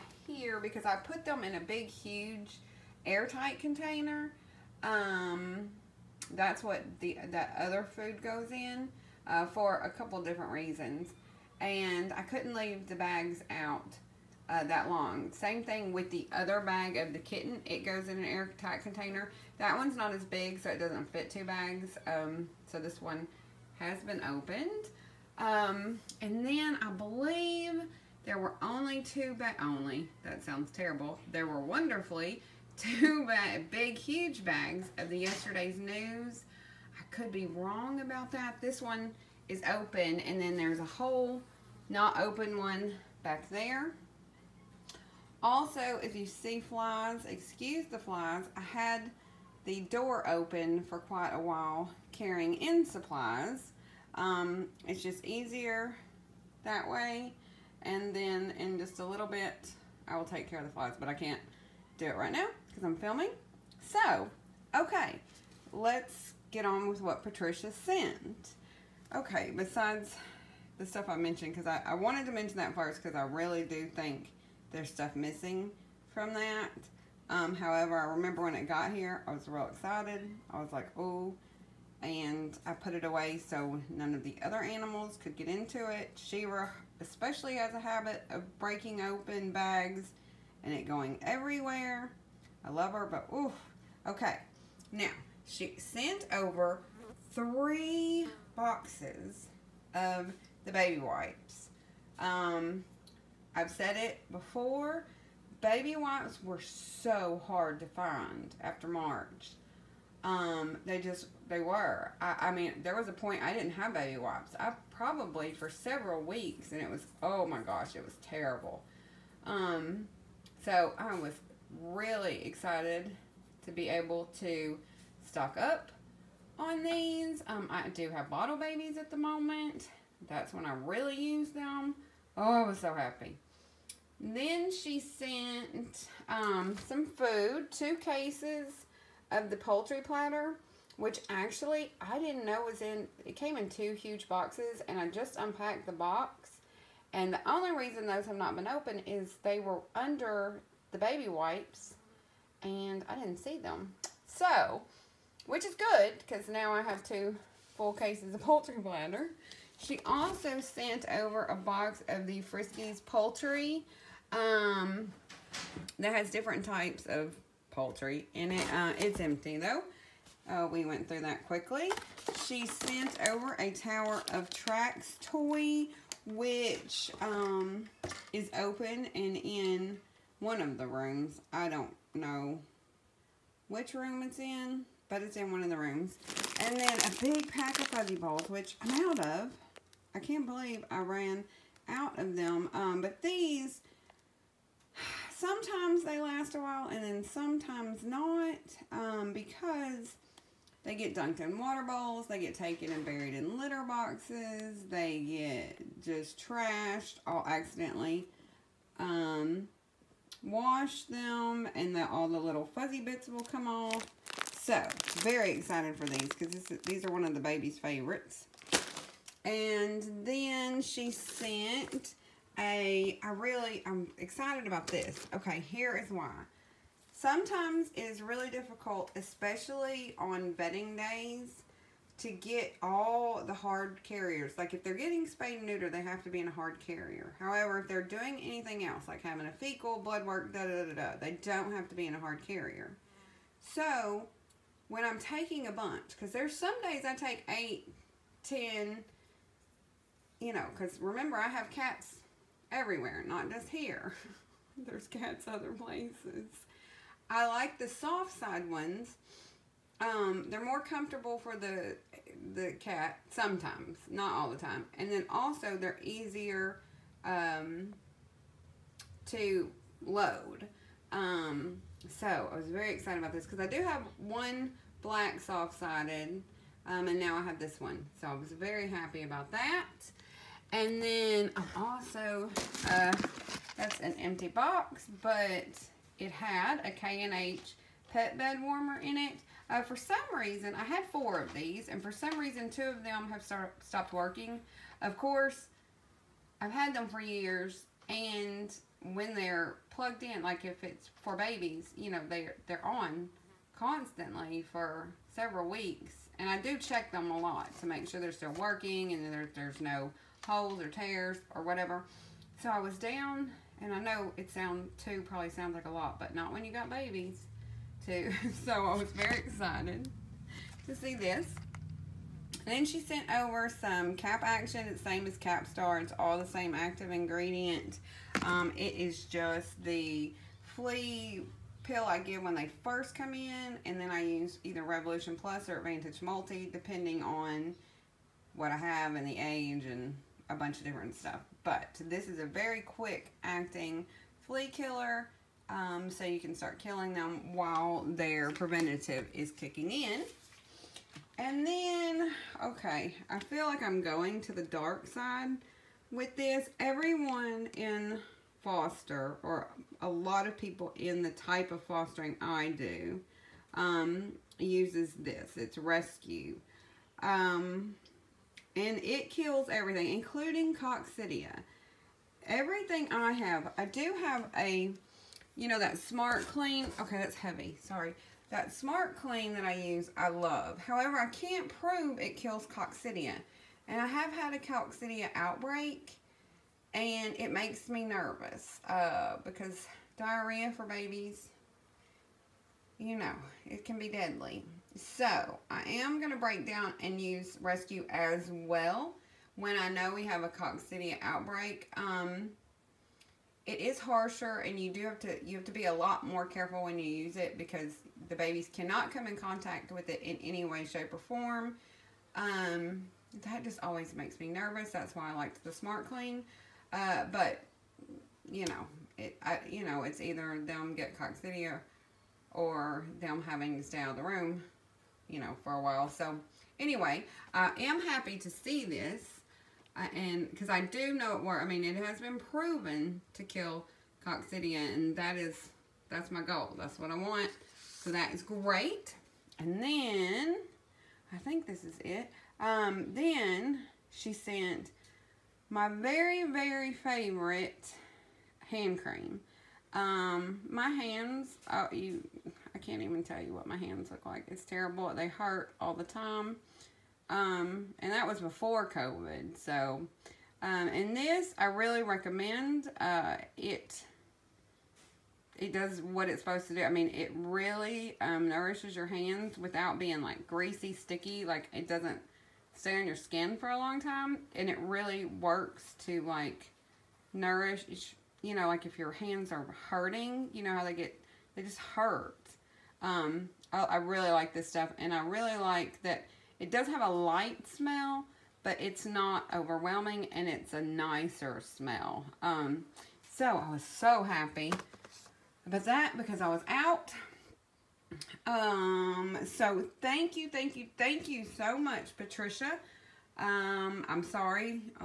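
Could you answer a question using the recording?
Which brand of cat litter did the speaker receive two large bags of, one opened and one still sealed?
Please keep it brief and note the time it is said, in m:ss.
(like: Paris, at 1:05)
Yesterday's News, at 0:35.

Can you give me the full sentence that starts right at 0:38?
This one is open and then there's a whole not open one back there.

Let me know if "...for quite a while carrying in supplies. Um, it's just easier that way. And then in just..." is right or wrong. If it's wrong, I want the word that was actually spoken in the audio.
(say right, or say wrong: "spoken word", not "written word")
right.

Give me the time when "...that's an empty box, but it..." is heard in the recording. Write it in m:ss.
4:43.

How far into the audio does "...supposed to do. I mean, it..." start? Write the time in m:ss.
7:46.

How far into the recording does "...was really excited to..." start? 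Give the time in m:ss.
2:01.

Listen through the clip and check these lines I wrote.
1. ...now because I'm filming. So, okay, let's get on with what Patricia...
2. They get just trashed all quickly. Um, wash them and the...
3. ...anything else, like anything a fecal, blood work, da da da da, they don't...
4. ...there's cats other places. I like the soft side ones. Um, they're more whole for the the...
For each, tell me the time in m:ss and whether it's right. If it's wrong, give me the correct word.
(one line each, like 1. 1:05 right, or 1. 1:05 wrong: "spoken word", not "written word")
1. 1:02 right
2. 3:24 wrong: "accidentally", not "quickly"
3. 3:58 wrong: "having", not "anything"
4. 4:14 wrong: "comfortable", not "whole".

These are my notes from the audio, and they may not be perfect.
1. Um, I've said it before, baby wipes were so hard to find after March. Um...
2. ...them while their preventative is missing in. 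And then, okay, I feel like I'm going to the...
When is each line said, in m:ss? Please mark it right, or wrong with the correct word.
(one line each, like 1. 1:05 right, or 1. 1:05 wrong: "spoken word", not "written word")
1. 1:42 right
2. 5:47 wrong: "kicking", not "missing".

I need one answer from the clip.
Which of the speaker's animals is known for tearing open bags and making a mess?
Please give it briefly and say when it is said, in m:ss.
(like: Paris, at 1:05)
Shira, at 1:26.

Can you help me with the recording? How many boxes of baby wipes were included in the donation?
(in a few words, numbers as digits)
3.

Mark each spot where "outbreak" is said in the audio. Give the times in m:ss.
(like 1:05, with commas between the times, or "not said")
6:25, 6:41.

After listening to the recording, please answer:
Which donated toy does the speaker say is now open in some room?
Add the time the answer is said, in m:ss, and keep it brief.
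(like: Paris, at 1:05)
Tower of Tracks, at 2:53.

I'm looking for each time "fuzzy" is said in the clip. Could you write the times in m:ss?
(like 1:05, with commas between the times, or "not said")
3:07, 3:32.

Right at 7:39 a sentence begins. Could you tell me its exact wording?
So, um, and this I really recommend.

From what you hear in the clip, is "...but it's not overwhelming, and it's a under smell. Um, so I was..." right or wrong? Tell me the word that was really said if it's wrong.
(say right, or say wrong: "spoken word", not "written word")
wrong: "nicer", not "under".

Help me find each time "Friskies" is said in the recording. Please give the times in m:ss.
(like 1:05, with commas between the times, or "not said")
2:42.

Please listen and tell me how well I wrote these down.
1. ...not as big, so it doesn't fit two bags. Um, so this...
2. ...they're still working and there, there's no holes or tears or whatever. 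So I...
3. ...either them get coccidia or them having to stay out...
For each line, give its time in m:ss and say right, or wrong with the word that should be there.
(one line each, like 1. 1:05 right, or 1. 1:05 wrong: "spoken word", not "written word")
1. 0:19 right
2. 5:08 right
3. 7:00 right.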